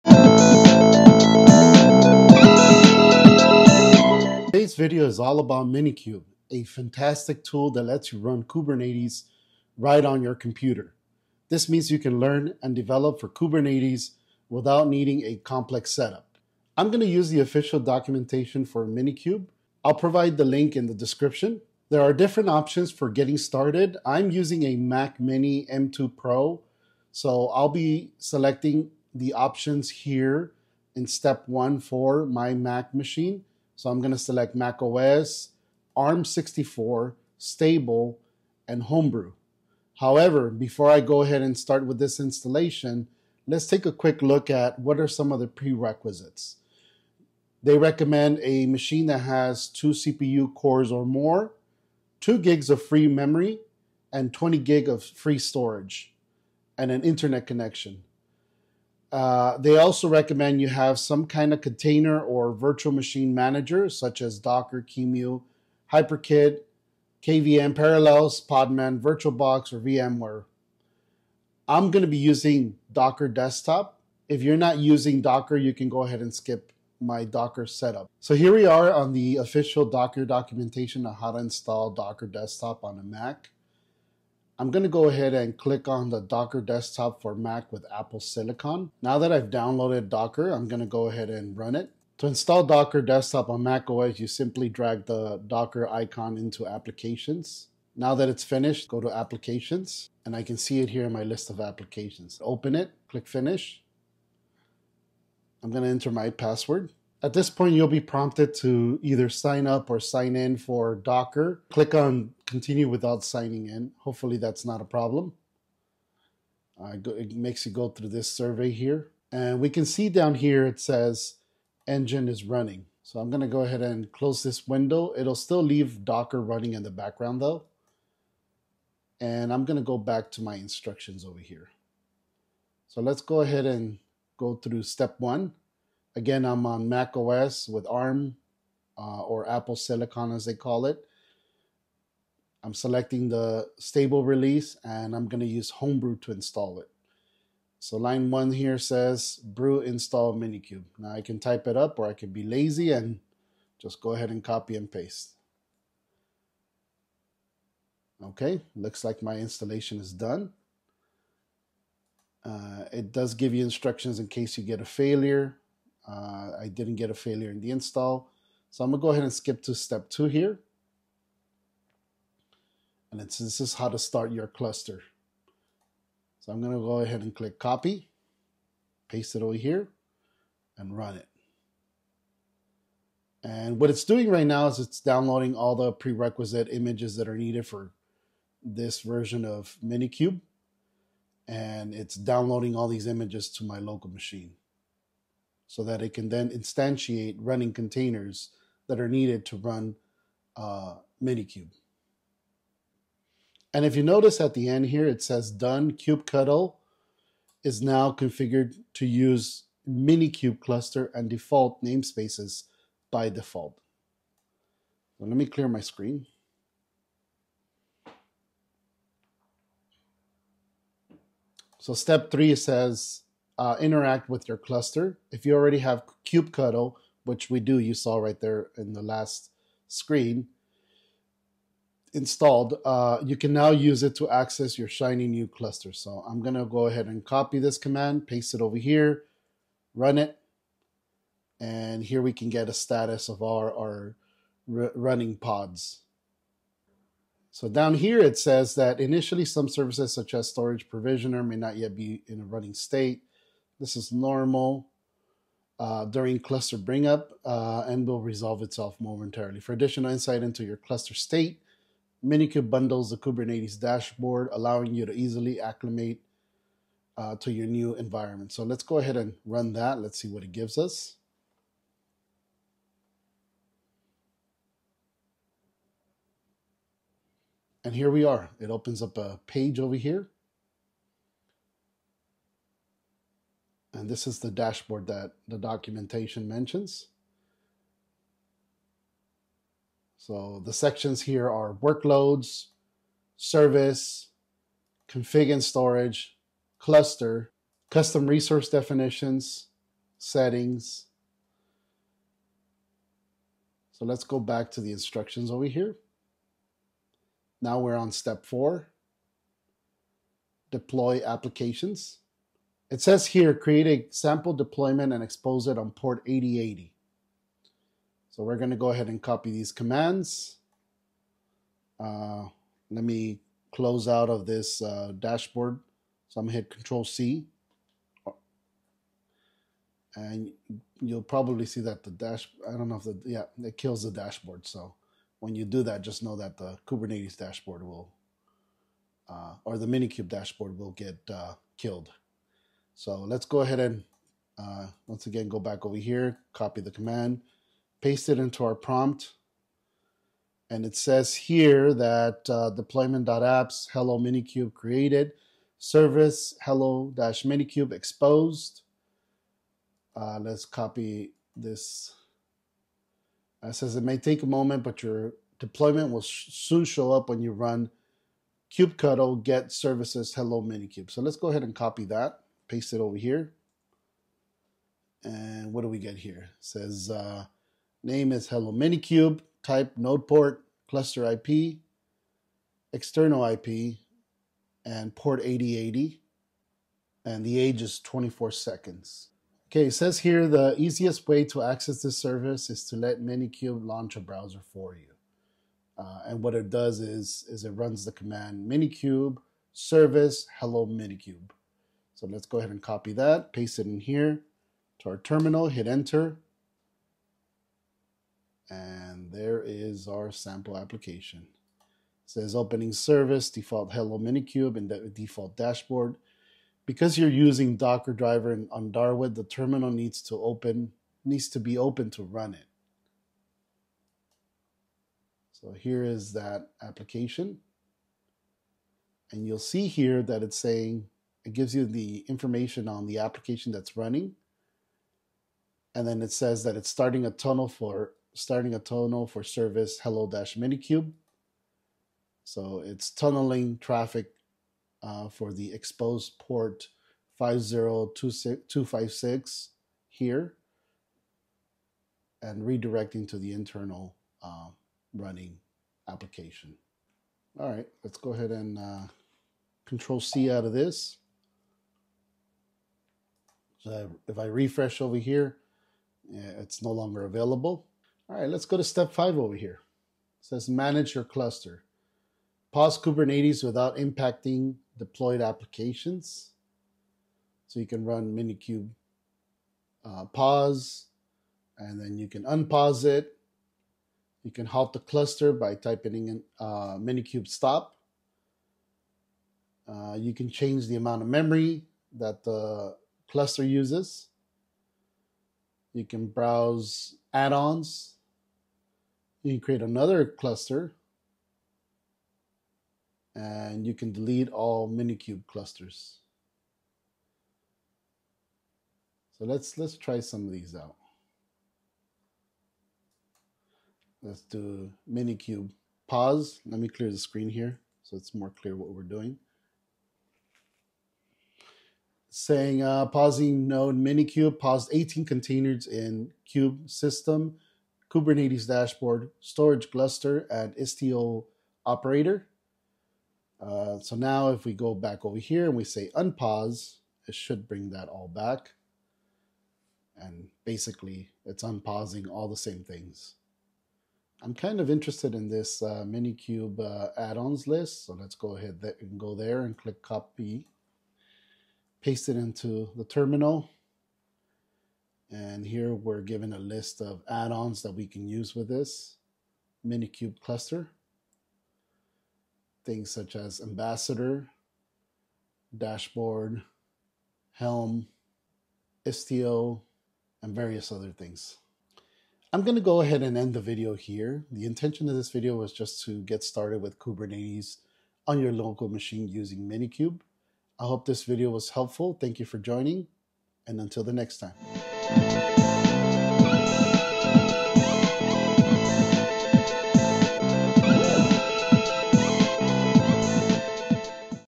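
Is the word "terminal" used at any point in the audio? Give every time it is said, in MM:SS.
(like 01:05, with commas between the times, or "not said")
06:45, 06:59, 09:13.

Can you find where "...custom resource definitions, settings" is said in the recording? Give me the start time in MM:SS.
04:57.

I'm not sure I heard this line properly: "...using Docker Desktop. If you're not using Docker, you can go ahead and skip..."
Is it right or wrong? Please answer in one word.
right.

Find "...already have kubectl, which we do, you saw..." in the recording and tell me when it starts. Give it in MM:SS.
03:45.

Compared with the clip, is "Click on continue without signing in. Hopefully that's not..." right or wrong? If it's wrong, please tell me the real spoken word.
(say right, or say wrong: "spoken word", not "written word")
right.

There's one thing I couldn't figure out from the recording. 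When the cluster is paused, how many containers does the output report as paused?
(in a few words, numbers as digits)
18.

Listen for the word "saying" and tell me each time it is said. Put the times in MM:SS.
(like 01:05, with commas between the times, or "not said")
07:10, 08:42.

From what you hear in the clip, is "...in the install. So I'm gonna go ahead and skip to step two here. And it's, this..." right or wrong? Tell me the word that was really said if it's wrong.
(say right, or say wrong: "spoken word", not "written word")
right.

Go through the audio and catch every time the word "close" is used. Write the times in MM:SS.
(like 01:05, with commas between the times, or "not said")
02:04, 05:23.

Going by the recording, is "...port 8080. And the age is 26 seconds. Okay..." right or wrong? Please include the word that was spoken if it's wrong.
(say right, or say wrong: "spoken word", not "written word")
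wrong: "24", not "26".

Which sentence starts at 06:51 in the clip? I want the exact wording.
It says opening service, default hello minikube, and de default dashboard.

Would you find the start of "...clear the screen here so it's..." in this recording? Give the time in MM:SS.
08:36.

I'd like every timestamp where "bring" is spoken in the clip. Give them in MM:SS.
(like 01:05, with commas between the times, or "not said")
04:16, 08:57.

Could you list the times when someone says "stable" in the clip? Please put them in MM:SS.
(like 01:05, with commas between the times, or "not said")
00:37, 02:23.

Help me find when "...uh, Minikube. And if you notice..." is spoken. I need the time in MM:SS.
03:20.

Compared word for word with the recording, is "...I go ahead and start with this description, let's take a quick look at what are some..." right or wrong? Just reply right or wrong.
wrong.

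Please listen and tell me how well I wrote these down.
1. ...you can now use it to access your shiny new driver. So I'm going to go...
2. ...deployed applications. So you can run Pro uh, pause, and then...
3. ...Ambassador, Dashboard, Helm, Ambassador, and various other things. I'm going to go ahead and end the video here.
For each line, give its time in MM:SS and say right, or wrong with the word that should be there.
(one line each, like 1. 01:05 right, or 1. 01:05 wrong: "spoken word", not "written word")
1. 03:53 wrong: "cluster", not "driver"
2. 07:54 wrong: "Minikube", not "Pro"
3. 09:23 wrong: "Istio", not "Ambassador".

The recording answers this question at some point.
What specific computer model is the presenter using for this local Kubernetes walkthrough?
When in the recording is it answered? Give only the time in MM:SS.
00:24.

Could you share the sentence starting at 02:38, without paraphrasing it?
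Okay, looks like my installation is done.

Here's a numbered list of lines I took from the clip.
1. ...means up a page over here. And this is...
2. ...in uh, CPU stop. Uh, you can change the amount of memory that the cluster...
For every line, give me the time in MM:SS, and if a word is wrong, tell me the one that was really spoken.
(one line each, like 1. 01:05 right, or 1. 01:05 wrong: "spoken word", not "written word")
1. 04:38 wrong: "opens", not "means"
2. 08:06 wrong: "Minikube", not "CPU".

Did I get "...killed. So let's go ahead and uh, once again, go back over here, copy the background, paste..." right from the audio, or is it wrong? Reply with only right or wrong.
wrong.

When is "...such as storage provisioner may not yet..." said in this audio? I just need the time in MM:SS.
04:10.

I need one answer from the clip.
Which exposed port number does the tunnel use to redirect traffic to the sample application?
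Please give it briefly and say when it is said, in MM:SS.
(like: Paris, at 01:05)
50256, at 07:27.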